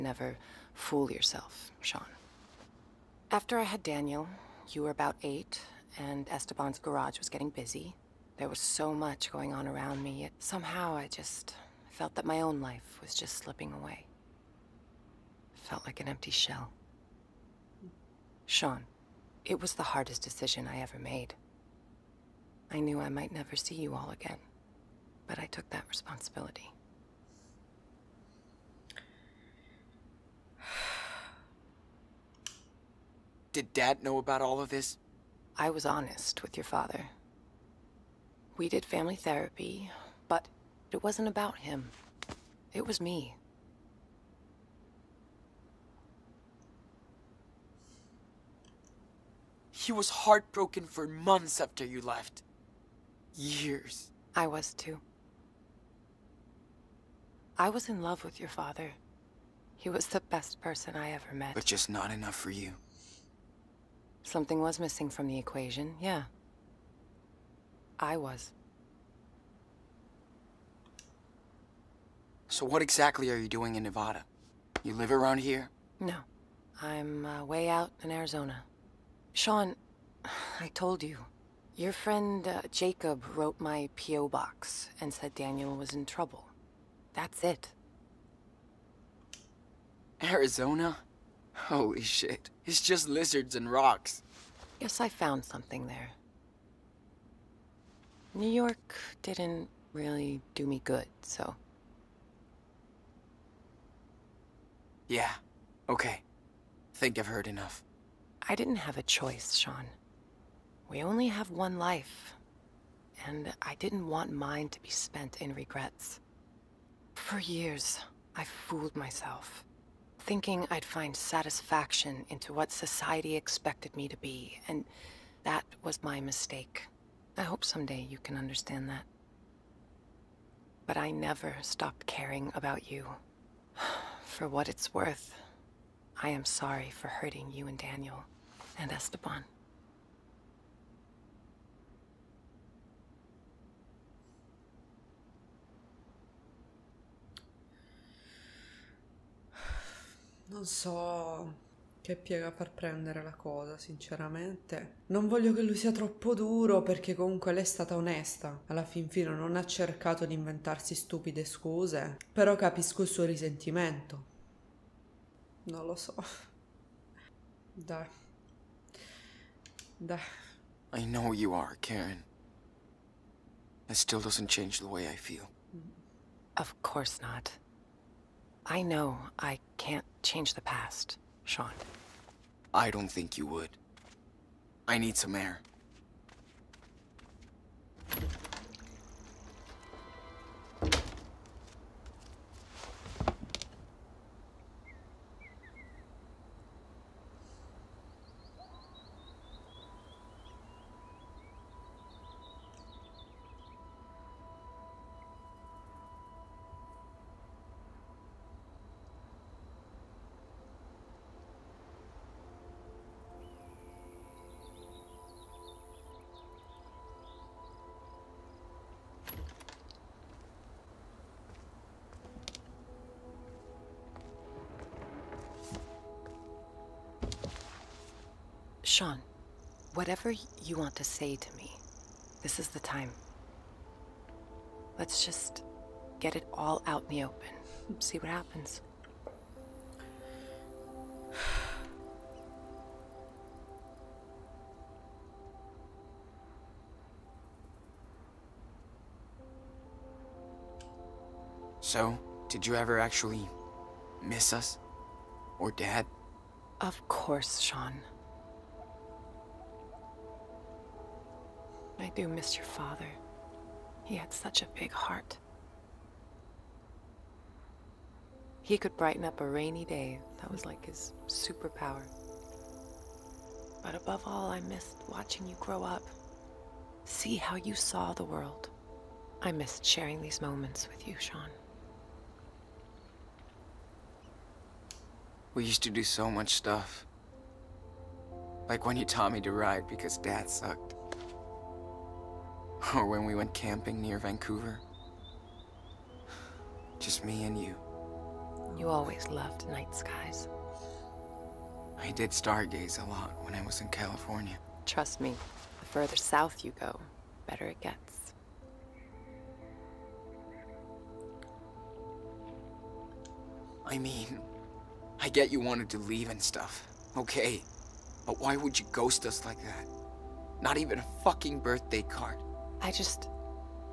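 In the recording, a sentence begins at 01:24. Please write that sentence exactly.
box and said Daniel was in trouble.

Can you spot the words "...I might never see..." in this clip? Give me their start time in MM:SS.
00:22.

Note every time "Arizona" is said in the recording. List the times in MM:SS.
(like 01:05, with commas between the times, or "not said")
01:18, 01:30.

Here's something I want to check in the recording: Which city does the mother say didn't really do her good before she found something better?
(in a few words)
New York.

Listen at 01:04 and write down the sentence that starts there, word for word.
Something was missing from the equation, yeah.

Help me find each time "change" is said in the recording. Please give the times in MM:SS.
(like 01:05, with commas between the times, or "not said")
02:54, 03:00.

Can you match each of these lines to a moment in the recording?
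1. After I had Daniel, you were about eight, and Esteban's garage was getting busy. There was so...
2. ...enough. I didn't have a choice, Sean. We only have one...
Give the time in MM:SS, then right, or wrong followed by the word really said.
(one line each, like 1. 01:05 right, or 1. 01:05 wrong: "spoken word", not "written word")
1. 00:03 right
2. 01:47 right.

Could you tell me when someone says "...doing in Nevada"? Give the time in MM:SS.
01:13.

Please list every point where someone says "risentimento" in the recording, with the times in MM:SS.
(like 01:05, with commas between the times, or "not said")
02:43.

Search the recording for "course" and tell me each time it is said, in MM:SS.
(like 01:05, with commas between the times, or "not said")
02:56, 04:17.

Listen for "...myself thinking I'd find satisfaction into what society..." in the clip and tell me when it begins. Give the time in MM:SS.
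01:58.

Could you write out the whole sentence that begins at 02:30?
Non so che piega far prendere la cosa, sinceramente.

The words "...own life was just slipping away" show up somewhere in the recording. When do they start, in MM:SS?
00:12.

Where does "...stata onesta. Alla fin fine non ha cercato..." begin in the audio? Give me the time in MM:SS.
02:37.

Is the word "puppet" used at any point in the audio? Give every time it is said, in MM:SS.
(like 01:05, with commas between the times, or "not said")
not said.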